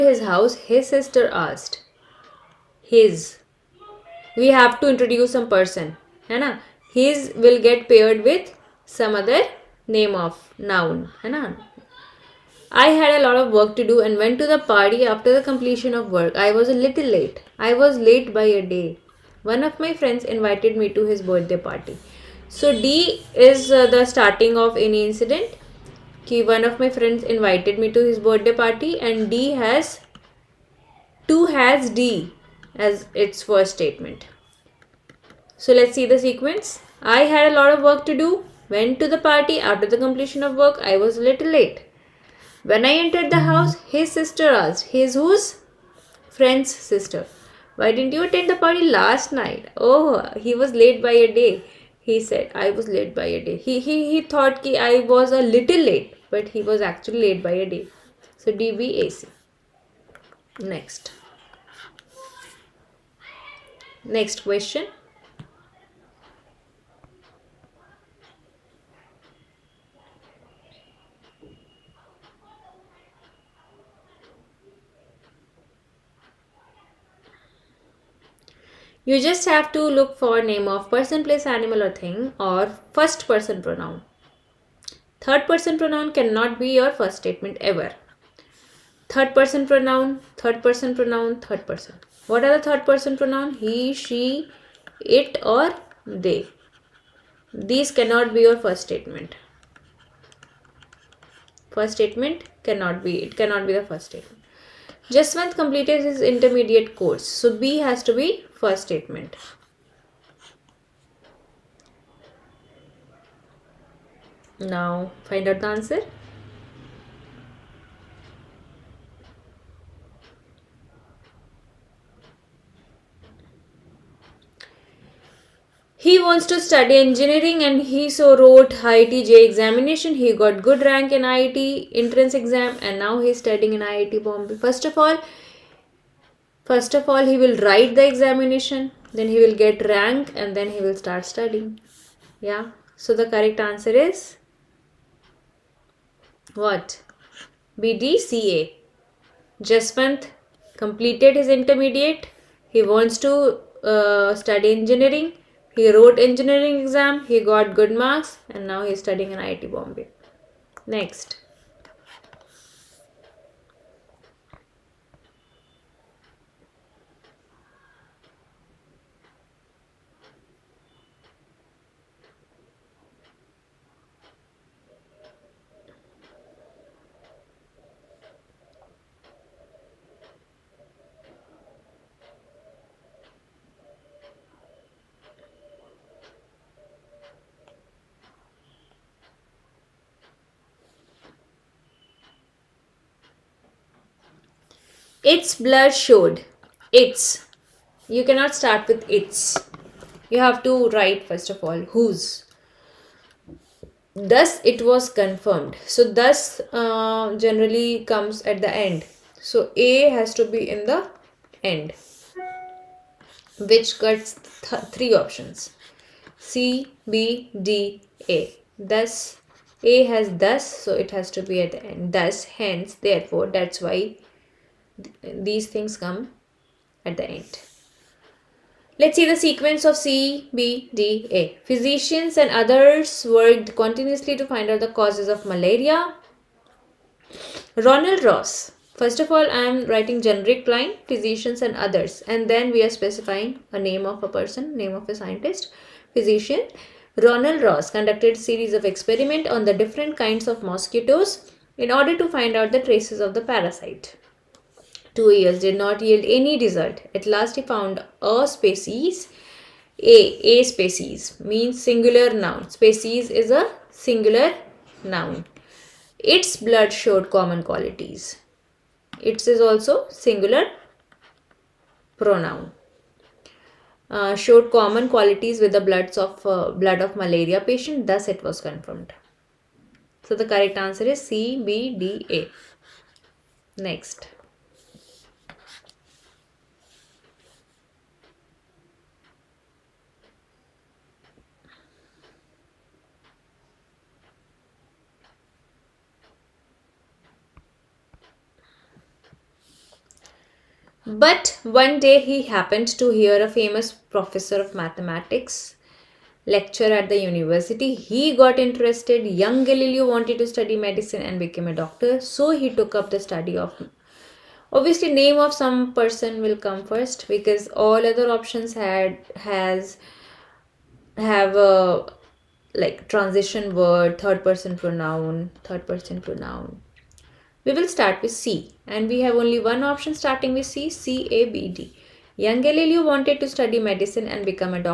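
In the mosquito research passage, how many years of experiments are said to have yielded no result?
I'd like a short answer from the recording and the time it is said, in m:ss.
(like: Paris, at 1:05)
2, at 4:15.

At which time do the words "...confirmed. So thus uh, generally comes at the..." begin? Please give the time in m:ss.
3:25.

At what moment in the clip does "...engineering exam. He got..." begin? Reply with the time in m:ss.
2:36.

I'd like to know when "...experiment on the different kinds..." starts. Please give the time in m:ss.
4:08.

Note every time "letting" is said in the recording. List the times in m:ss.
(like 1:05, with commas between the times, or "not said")
not said.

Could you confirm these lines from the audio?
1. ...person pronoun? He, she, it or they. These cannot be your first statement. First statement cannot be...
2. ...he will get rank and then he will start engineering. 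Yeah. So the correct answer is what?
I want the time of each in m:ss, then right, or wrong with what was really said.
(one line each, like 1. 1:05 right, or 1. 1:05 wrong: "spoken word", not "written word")
1. 1:32 right
2. 2:19 wrong: "studying", not "engineering".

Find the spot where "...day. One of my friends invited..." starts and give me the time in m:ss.
0:18.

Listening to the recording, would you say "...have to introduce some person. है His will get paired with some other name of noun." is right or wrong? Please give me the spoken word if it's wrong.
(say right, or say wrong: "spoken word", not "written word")
right.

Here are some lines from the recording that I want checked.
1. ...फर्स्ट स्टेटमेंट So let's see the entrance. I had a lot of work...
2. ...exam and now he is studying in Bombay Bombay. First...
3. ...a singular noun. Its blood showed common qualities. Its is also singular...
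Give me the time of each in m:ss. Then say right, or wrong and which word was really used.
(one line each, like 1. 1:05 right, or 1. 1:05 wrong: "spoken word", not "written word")
1. 0:33 wrong: "sequence", not "entrance"
2. 2:12 wrong: "IIT", not "Bombay"
3. 4:23 right.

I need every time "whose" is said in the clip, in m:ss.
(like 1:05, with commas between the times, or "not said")
0:45, 3:21.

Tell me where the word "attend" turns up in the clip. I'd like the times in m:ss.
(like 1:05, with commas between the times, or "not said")
0:48.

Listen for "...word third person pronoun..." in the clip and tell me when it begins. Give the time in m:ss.
5:23.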